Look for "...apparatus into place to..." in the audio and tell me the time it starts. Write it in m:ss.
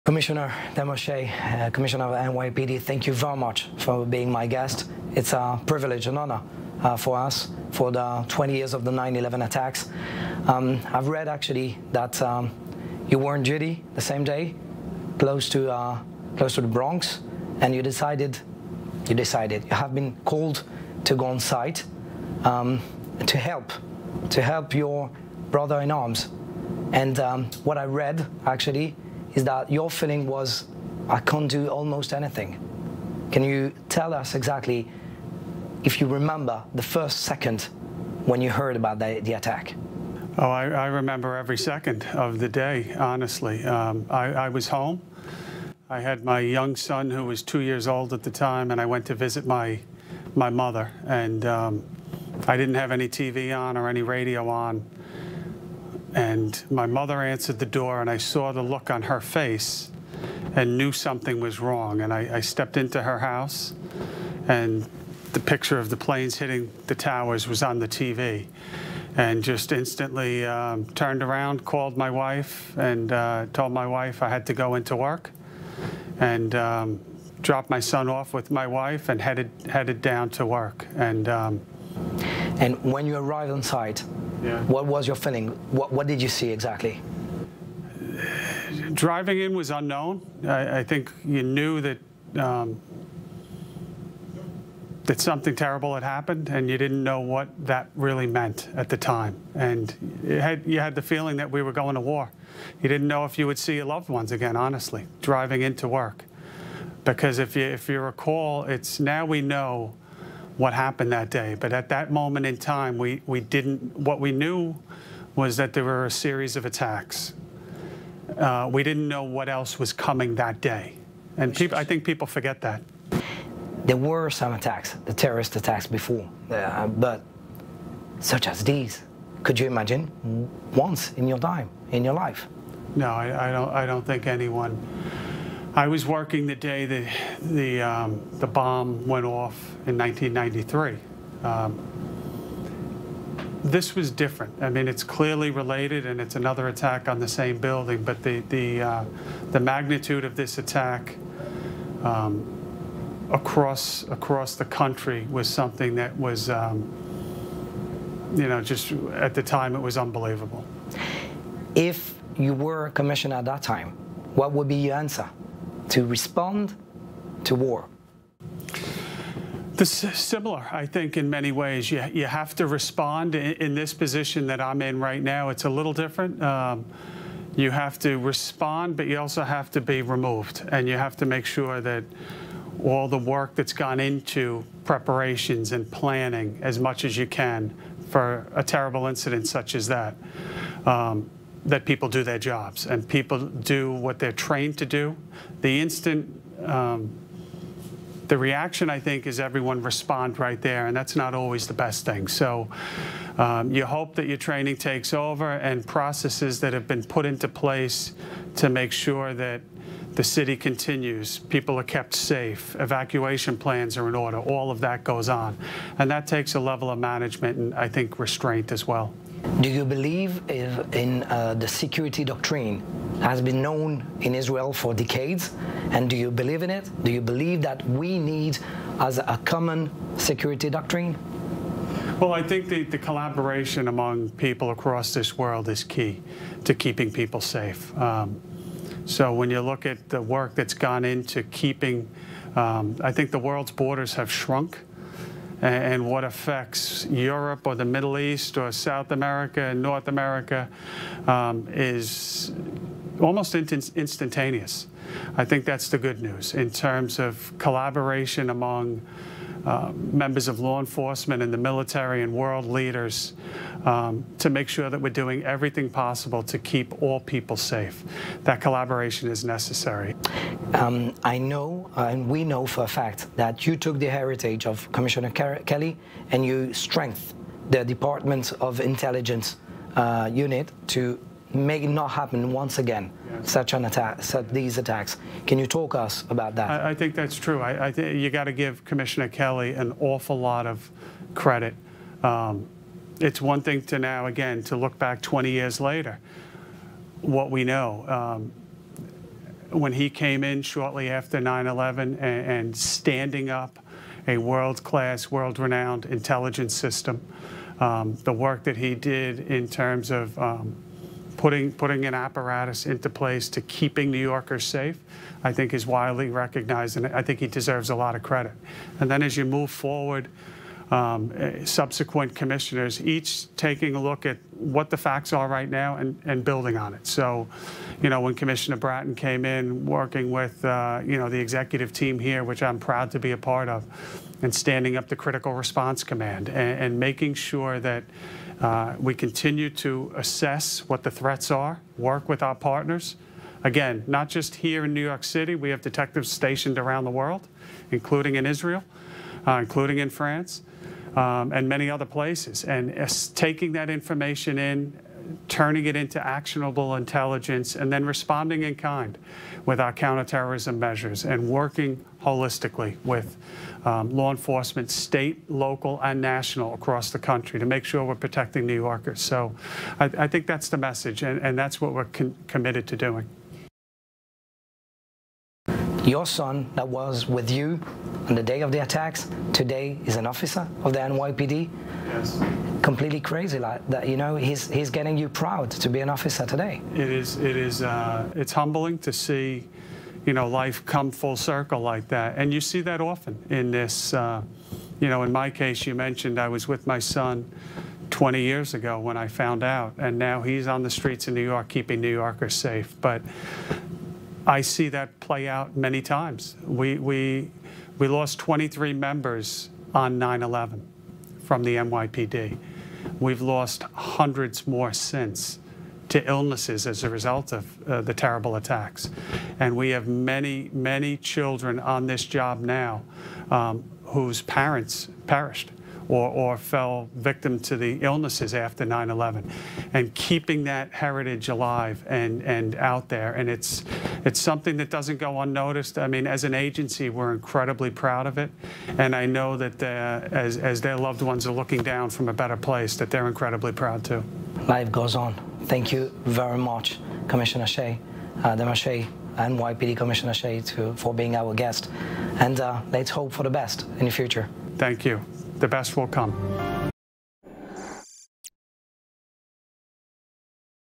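5:12.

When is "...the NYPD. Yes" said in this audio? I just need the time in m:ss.
6:20.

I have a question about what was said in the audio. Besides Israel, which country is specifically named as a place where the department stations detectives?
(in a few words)
France.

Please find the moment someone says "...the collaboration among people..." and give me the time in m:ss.
3:52.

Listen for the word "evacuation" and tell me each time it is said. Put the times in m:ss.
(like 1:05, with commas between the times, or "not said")
3:32.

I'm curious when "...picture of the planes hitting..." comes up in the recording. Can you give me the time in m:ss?
1:05.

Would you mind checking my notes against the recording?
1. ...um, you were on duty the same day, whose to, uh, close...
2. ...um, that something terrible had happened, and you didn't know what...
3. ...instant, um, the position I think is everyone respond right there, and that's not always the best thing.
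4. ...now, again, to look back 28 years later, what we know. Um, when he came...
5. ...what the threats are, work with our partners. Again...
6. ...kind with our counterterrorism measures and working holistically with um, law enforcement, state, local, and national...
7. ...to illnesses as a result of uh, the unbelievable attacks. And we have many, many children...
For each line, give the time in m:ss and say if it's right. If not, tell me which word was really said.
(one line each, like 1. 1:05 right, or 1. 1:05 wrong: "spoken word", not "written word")
1. 0:12 wrong: "close", not "whose"
2. 1:32 right
3. 3:15 wrong: "reaction", not "position"
4. 4:53 wrong: "20", not "28"
5. 5:40 right
6. 5:58 right
7. 6:56 wrong: "terrible", not "unbelievable".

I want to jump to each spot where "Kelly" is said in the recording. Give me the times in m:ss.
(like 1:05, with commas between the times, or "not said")
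4:35, 4:49.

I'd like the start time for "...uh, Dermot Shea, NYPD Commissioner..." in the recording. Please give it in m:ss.
7:28.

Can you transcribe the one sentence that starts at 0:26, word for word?
And um, what I read actually is that your feeling was, I can't do almost anything.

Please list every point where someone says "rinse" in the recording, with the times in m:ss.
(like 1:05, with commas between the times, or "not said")
not said.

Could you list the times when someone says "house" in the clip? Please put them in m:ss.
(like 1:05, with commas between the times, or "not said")
1:03.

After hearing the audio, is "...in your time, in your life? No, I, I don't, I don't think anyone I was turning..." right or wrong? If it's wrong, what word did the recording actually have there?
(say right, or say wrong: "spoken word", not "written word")
wrong: "working", not "turning".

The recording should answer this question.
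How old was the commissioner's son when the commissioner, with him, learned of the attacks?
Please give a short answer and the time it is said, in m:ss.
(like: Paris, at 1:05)
2 years old, at 0:47.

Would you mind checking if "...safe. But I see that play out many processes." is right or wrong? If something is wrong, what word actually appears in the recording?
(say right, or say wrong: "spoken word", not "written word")
wrong: "times", not "processes".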